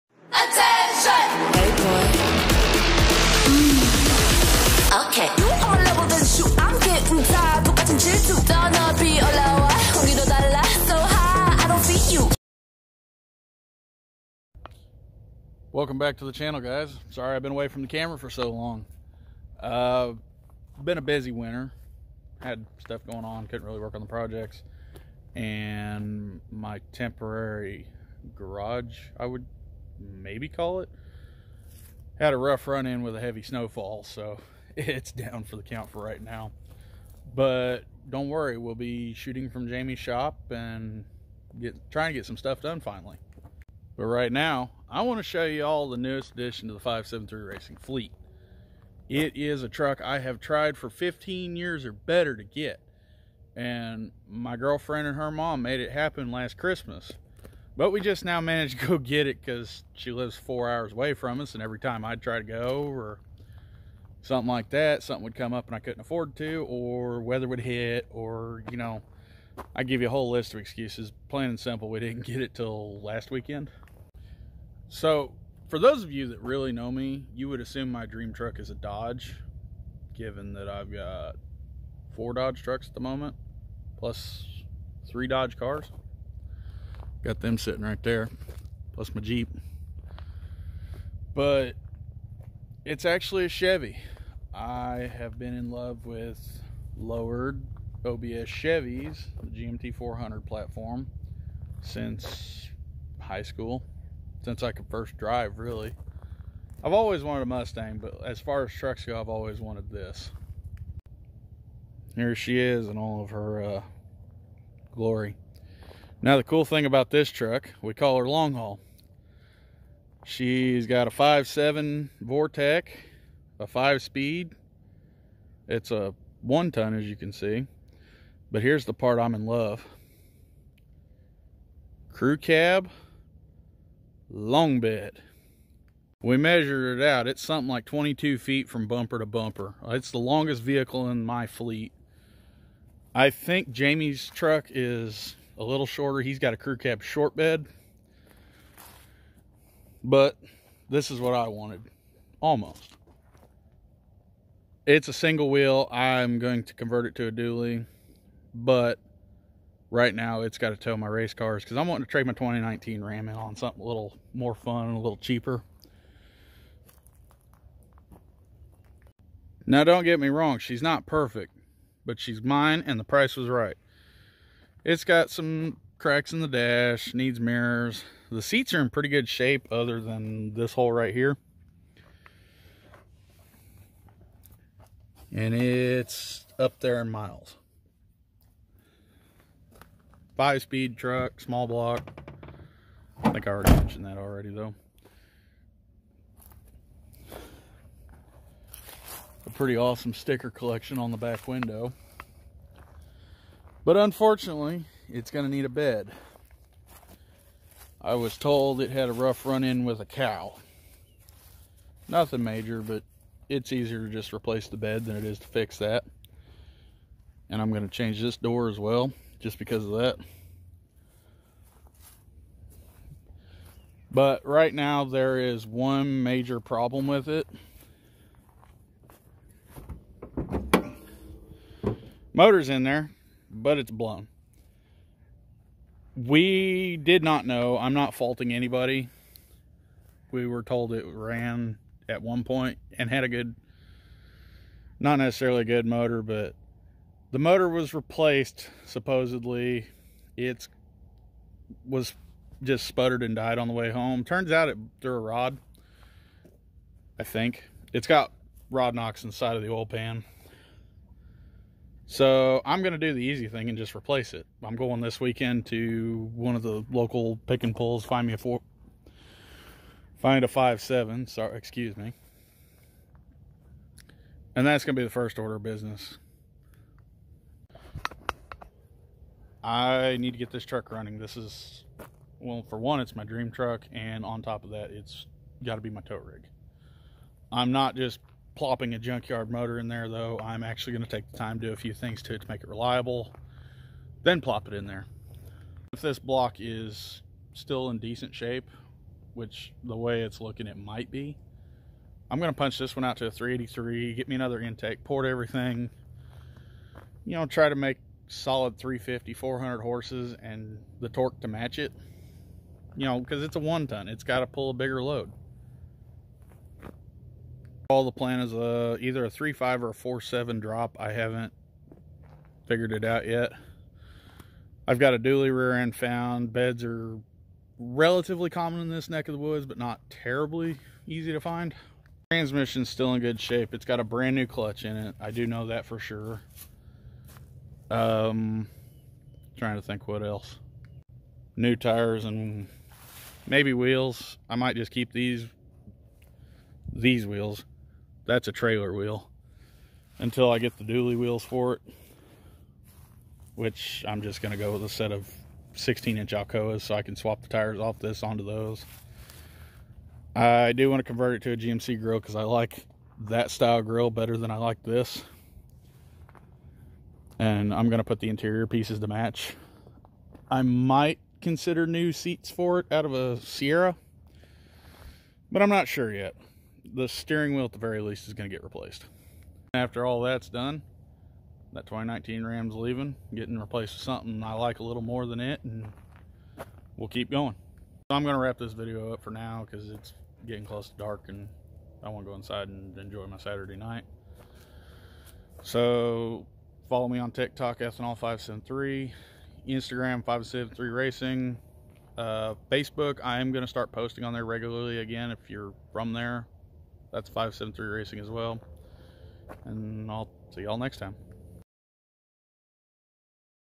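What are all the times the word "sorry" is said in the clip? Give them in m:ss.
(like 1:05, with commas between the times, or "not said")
0:17, 4:31.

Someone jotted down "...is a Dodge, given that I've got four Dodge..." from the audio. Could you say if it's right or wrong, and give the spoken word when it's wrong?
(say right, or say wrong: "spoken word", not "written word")
right.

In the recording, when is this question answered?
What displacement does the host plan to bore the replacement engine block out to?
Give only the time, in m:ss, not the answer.
5:03.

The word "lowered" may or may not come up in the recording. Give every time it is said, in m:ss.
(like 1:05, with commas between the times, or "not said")
1:36.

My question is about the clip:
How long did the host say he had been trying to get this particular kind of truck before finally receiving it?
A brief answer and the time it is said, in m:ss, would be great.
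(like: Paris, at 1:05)
15 years, at 0:50.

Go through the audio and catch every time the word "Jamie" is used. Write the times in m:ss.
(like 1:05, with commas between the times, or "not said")
0:39, 2:23.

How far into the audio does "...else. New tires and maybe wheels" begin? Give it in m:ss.
5:40.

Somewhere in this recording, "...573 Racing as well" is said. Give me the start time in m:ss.
6:47.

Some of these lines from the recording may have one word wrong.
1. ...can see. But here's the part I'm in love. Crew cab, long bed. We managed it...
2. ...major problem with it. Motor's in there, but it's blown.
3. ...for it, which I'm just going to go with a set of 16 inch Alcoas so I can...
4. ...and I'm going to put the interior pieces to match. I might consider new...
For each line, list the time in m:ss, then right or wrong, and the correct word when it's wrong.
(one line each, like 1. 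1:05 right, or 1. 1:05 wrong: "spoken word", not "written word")
1. 2:07 wrong: "measured", not "managed"
2. 3:46 right
3. 5:51 right
4. 6:07 right.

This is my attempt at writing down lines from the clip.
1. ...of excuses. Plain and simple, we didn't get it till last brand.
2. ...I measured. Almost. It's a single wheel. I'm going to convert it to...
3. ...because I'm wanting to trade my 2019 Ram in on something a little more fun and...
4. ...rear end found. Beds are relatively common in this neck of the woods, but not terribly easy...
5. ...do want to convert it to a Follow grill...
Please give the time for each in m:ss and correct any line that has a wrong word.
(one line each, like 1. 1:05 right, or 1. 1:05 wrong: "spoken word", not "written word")
1. 1:10 wrong: "weekend", not "brand"
2. 2:31 wrong: "wanted", not "measured"
3. 2:41 right
4. 5:25 right
5. 6:00 wrong: "GMC", not "Follow".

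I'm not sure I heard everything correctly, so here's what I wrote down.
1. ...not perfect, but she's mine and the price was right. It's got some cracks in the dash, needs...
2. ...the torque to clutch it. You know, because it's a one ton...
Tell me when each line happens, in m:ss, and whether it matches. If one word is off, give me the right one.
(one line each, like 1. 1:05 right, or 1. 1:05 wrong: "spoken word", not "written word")
1. 2:50 right
2. 5:10 wrong: "match", not "clutch".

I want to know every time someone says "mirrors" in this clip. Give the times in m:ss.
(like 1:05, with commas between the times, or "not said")
2:57.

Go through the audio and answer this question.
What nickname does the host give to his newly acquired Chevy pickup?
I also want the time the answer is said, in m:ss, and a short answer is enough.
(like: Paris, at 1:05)
long haul, at 1:58.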